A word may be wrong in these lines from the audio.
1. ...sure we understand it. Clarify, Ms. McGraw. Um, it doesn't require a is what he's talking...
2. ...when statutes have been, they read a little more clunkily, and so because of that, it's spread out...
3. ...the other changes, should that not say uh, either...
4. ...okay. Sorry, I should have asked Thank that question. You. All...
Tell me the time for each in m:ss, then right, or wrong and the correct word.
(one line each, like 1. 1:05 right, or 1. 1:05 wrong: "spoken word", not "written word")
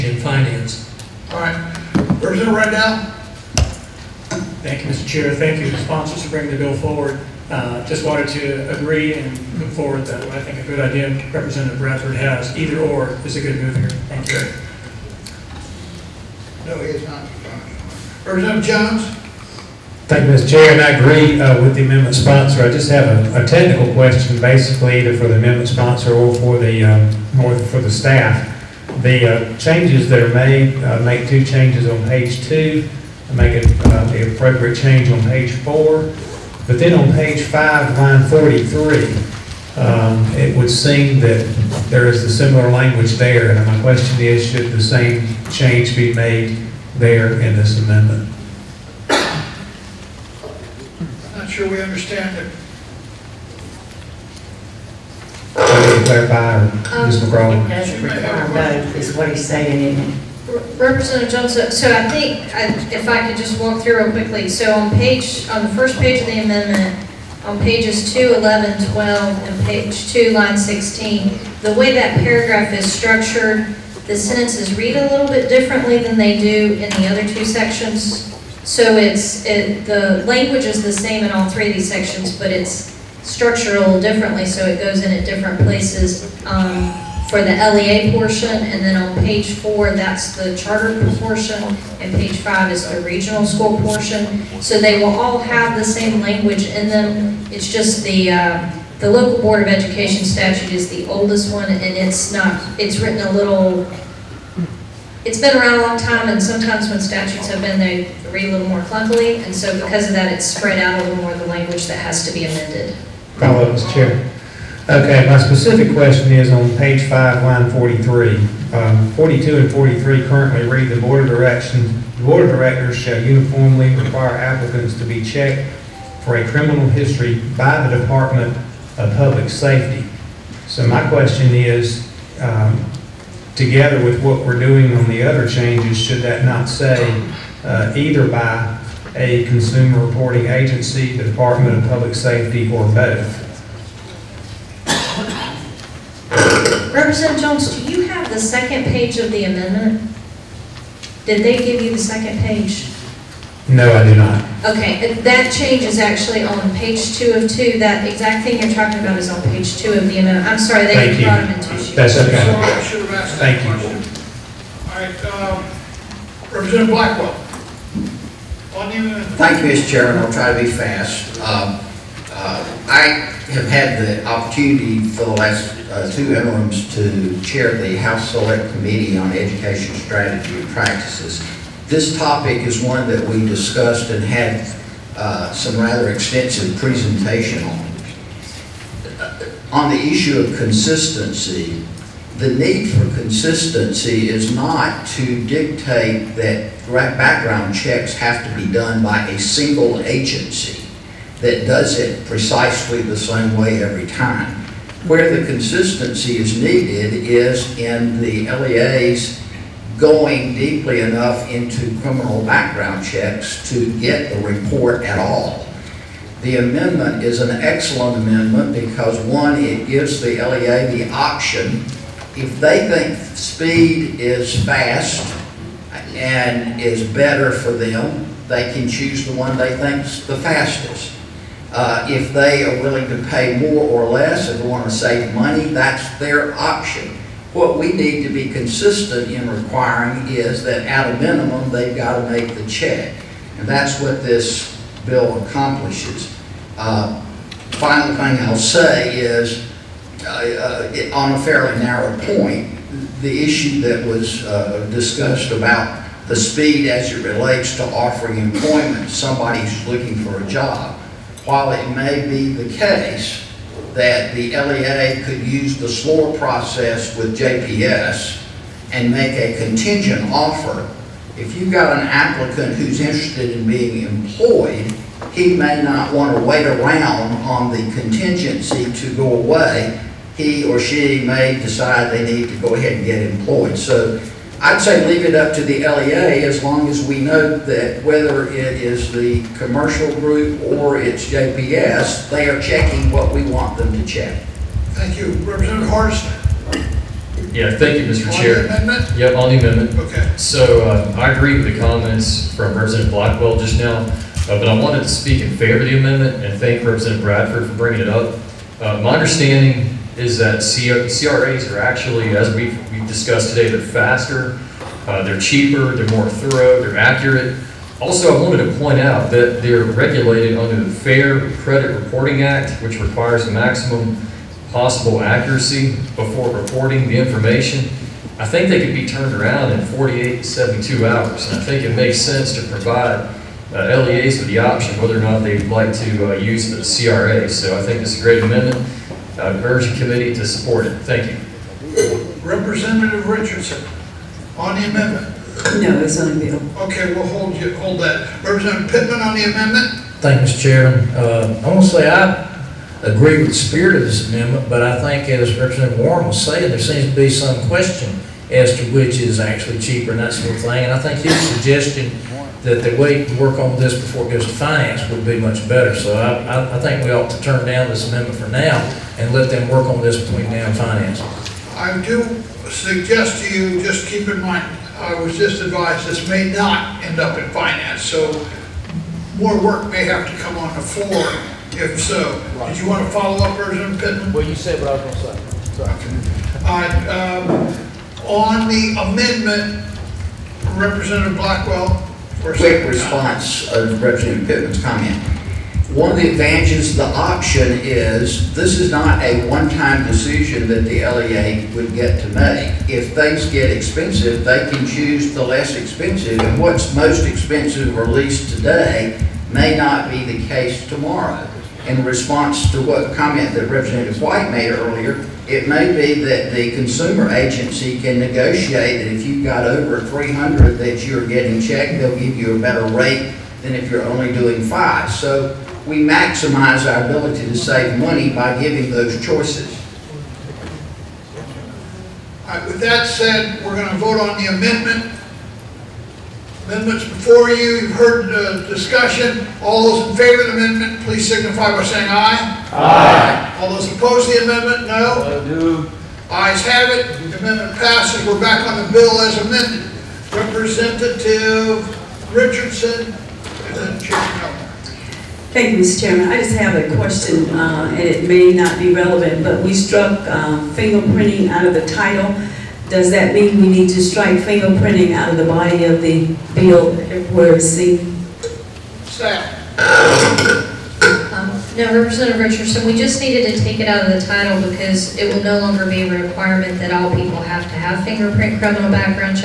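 1. 0:51 wrong: "saying", not "talking"
2. 1:46 right
3. 2:15 right
4. 2:42 right.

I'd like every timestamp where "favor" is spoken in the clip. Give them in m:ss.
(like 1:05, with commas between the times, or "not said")
5:05, 7:20.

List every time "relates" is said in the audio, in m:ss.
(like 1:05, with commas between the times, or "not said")
4:17.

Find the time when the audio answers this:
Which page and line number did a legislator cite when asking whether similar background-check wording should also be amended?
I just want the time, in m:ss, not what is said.
0:37.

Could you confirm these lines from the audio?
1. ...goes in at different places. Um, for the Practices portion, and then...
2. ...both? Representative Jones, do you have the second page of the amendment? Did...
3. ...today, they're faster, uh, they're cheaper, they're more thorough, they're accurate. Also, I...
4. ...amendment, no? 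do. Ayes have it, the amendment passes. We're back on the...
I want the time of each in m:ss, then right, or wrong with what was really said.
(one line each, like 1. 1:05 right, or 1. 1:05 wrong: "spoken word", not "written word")
1. 1:24 wrong: "LEA", not "Practices"
2. 2:22 right
3. 5:13 right
4. 7:24 right.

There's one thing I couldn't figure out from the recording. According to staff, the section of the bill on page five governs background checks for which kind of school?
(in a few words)
regional school.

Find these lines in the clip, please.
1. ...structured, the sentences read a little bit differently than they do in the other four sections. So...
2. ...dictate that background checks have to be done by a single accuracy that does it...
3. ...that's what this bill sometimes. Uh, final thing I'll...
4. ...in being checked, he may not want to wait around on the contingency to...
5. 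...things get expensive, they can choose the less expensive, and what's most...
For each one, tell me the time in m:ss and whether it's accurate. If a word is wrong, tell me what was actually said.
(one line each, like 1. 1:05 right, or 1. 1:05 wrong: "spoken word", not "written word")
1. 1:12 wrong: "two", not "four"
2. 3:15 wrong: "agency", not "accuracy"
3. 4:03 wrong: "accomplishes", not "sometimes"
4. 4:33 wrong: "employed", not "checked"
5. 6:43 right.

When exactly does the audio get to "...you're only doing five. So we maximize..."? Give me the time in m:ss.
7:03.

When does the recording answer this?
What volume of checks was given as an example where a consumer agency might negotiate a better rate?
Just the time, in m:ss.
6:59.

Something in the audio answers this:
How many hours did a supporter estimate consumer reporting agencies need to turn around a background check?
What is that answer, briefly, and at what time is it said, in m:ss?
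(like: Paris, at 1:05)
48 to 72 hours, at 5:29.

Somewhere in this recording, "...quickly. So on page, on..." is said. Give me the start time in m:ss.
1:04.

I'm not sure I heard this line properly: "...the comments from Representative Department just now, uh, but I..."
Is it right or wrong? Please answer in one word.
wrong.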